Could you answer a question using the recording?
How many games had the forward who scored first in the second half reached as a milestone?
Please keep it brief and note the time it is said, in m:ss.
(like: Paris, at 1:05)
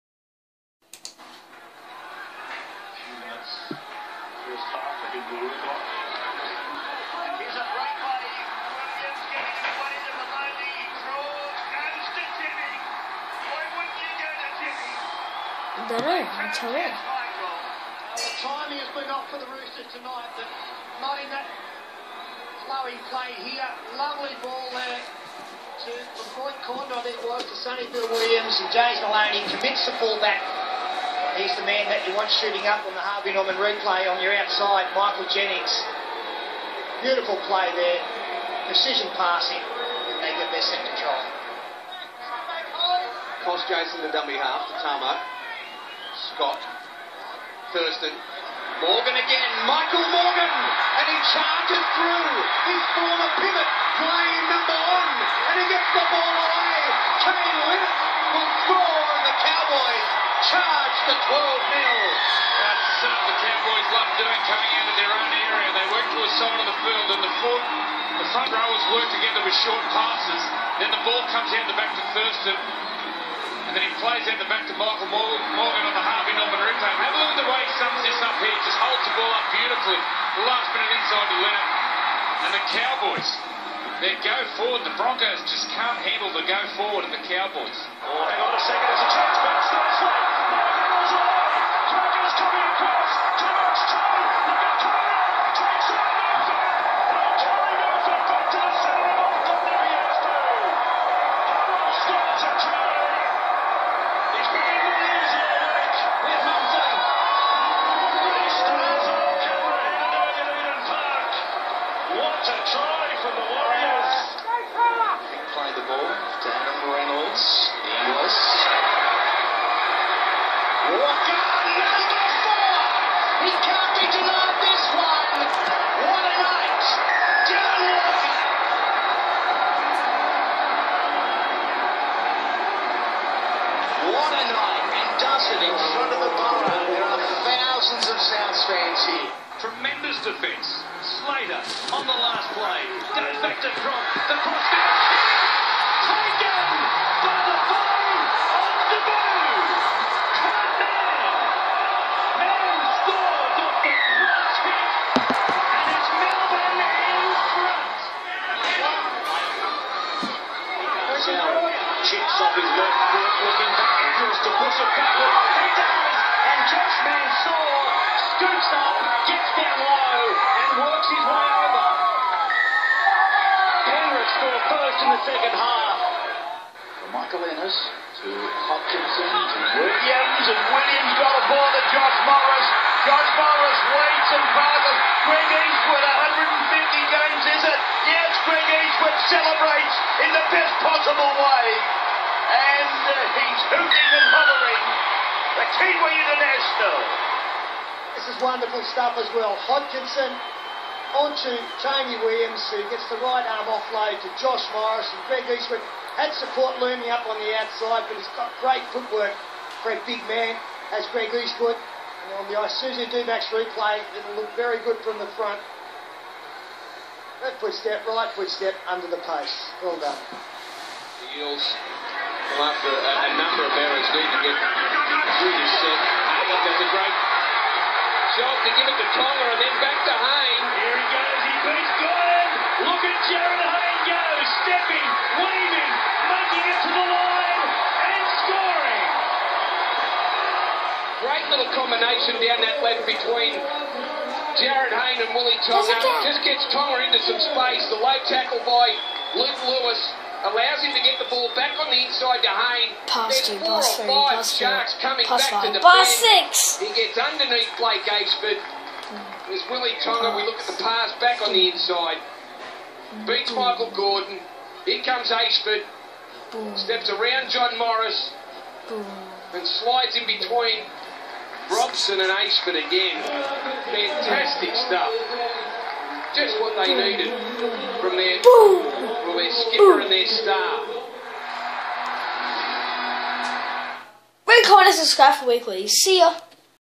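150, at 3:06.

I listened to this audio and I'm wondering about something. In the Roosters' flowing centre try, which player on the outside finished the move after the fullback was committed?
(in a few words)
Michael Jennings.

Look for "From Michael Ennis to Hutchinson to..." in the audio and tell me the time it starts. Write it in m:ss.
2:57.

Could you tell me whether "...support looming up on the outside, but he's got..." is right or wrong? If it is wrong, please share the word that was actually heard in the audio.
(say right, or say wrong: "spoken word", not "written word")
right.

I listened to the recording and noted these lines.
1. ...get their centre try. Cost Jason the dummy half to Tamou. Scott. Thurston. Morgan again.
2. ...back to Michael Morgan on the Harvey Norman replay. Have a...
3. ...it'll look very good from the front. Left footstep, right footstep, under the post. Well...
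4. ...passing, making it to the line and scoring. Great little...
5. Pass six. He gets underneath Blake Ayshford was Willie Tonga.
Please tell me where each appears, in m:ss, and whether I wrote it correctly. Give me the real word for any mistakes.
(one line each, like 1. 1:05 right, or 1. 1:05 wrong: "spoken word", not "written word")
1. 0:40 right
2. 1:14 right
3. 3:34 right
4. 3:55 wrong: "weaving", not "passing"
5. 4:15 right.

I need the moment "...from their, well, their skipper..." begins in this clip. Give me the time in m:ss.
4:37.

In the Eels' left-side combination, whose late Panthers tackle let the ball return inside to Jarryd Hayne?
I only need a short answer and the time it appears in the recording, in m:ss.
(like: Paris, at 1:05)
Luke Lewis, at 4:09.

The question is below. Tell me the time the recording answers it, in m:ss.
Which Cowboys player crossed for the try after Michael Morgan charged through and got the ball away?
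0:57.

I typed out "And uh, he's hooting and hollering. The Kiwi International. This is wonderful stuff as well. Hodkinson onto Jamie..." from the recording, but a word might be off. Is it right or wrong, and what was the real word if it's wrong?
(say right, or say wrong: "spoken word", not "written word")
right.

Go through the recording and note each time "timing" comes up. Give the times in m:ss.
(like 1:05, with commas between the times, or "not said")
0:16.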